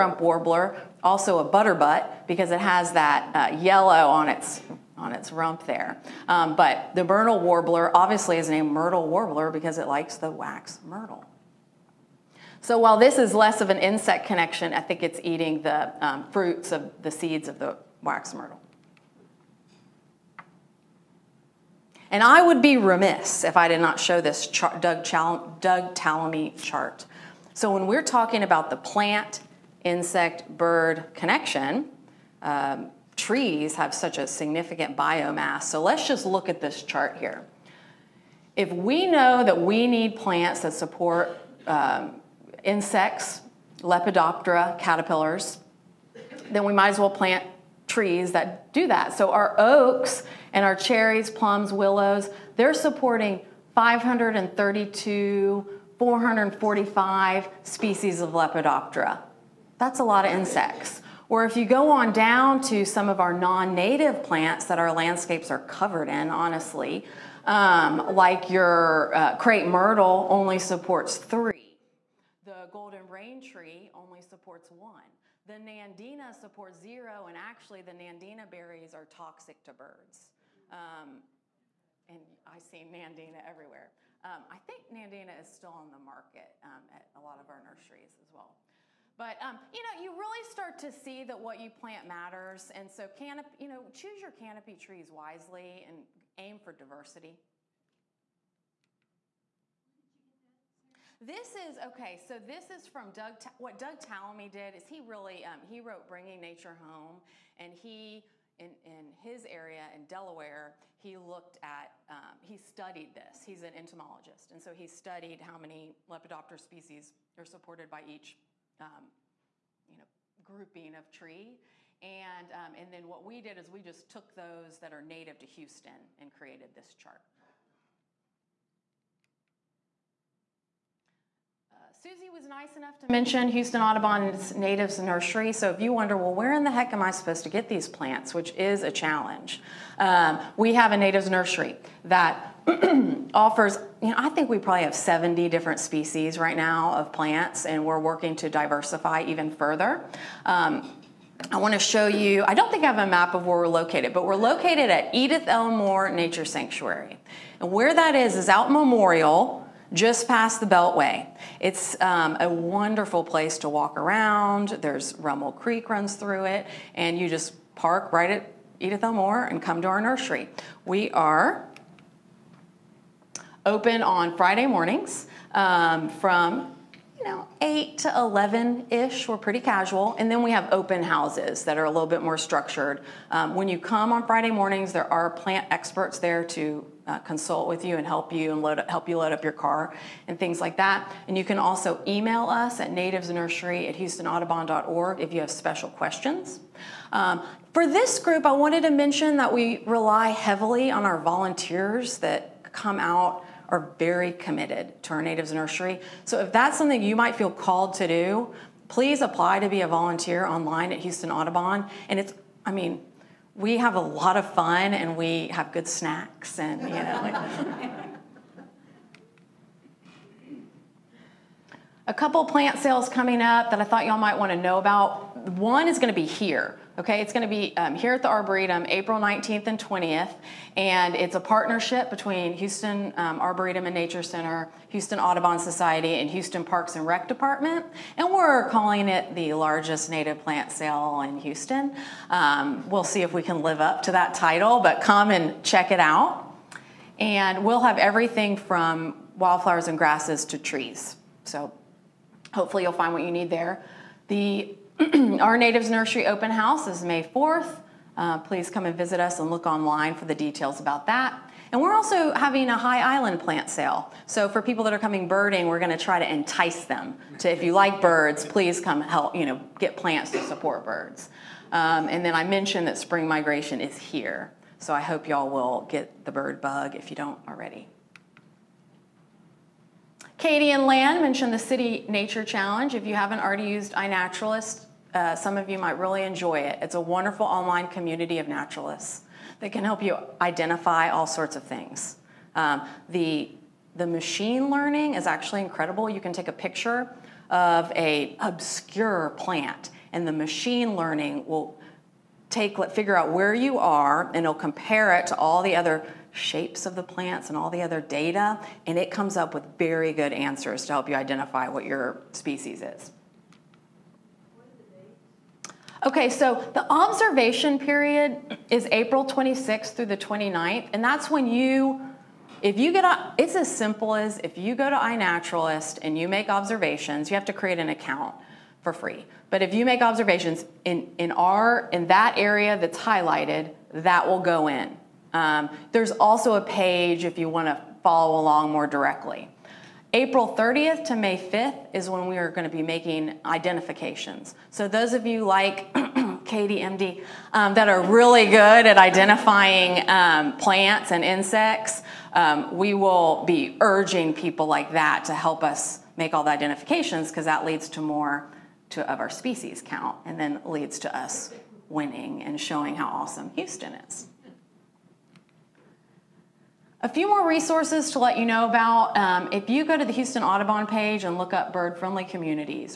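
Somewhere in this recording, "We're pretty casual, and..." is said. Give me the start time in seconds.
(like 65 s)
179 s.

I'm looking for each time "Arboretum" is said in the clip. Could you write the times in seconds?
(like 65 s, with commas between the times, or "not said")
228 s, 233 s.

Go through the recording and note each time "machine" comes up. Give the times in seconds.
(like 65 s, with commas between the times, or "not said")
294 s, 300 s.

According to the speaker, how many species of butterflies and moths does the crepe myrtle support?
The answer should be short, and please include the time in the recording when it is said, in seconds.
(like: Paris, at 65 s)
3, at 70 s.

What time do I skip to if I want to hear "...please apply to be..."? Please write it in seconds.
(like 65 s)
208 s.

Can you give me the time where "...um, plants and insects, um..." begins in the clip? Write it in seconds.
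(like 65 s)
350 s.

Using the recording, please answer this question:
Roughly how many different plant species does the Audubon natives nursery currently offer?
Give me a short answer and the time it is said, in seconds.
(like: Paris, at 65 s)
70, at 144 s.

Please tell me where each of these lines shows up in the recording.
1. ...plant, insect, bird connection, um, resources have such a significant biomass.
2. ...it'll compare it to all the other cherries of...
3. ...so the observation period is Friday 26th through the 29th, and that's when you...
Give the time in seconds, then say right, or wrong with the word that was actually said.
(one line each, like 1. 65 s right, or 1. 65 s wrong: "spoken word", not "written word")
1. 28 s wrong: "trees", not "resources"
2. 304 s wrong: "shapes", not "cherries"
3. 316 s wrong: "April", not "Friday".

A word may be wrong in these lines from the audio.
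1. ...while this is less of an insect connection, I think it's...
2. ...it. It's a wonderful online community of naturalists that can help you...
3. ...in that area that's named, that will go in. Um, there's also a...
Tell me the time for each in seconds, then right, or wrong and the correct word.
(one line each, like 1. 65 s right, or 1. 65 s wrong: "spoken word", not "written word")
1. 12 s right
2. 286 s right
3. 331 s wrong: "highlighted", not "named".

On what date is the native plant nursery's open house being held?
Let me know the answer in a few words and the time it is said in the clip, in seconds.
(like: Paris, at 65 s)
May 4th, at 257 s.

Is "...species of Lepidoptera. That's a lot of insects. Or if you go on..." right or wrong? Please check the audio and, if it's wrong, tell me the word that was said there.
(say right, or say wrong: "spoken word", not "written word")
right.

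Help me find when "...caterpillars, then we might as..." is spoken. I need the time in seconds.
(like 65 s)
44 s.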